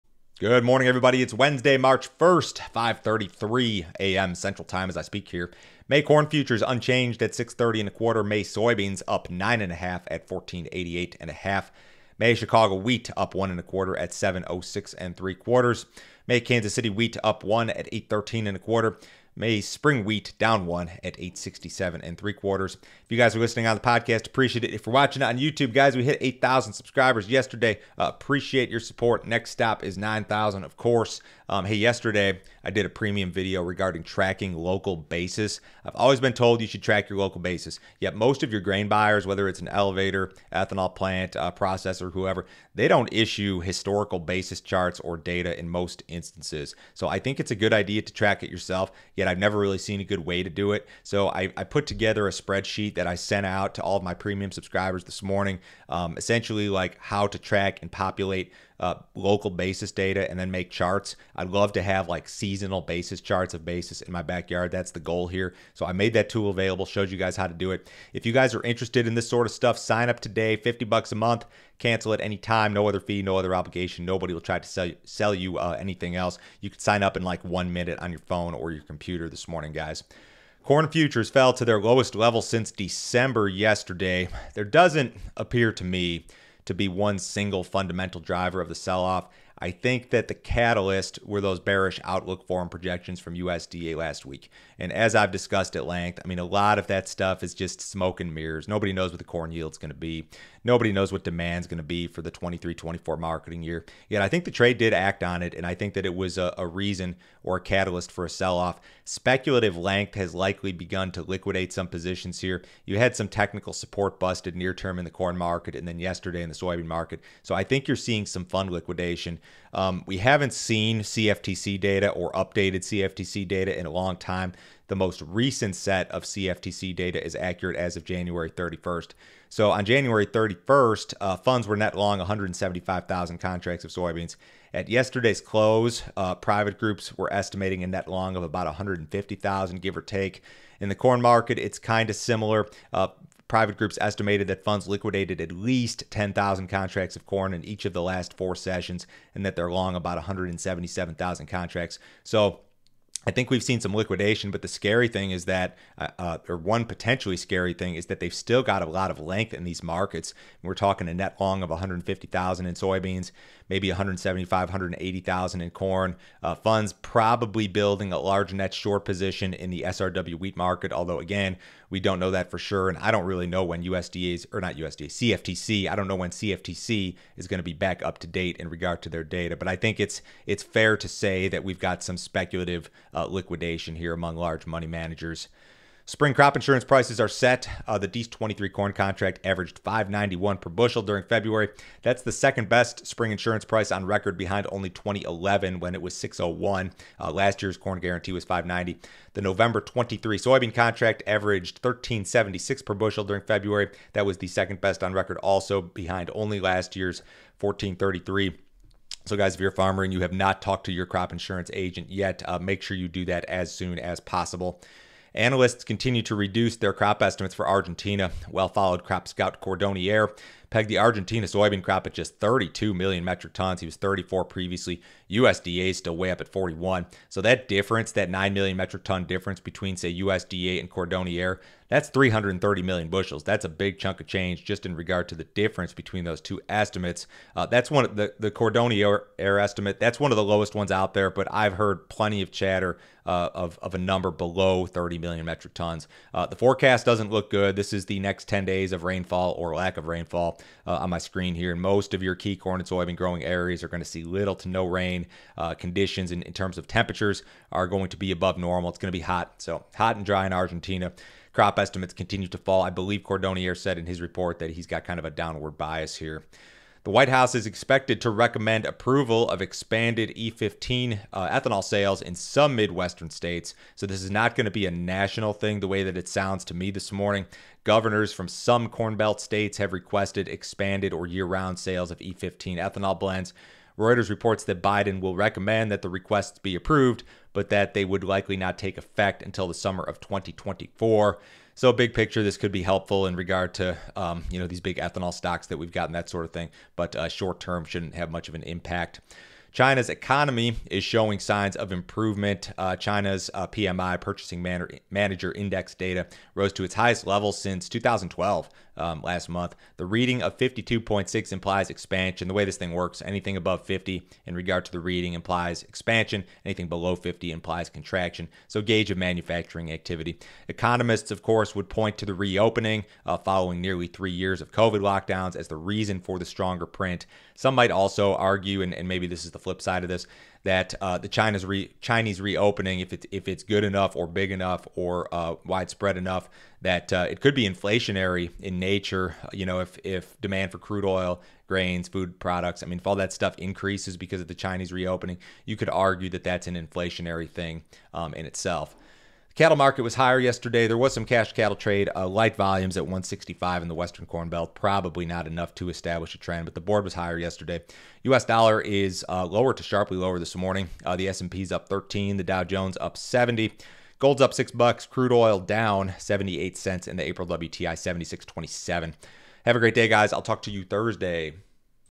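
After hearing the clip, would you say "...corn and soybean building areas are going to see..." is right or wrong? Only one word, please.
wrong.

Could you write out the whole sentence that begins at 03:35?
Analysts continue to reduce their crop estimates for Argentina.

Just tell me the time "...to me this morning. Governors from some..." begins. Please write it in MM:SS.
04:36.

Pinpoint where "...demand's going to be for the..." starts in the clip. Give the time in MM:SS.
01:41.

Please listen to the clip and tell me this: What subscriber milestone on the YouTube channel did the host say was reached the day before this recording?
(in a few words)
8,000.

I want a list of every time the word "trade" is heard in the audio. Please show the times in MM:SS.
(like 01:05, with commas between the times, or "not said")
01:44, 05:51.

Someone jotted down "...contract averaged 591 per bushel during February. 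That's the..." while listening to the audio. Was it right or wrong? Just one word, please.
right.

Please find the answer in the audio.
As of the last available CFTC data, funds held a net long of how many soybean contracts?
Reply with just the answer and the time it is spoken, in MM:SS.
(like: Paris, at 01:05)
175,000, at 02:12.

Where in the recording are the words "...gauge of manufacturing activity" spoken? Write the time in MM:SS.
05:18.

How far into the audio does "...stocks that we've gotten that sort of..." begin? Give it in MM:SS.
04:55.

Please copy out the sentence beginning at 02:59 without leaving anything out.
But I think it's it's fair to say that we've got some speculative uh, liquidation here among large money managers.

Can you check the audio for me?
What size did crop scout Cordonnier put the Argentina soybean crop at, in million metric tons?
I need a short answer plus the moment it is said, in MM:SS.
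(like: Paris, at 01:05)
32, at 03:42.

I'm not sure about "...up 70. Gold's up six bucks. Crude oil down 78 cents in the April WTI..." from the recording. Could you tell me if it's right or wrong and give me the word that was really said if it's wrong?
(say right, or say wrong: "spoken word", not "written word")
right.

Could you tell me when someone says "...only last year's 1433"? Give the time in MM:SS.
03:26.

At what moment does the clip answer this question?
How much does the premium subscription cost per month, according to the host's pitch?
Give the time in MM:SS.
01:10.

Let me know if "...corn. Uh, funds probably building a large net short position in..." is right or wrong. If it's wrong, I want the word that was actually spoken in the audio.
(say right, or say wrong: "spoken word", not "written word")
right.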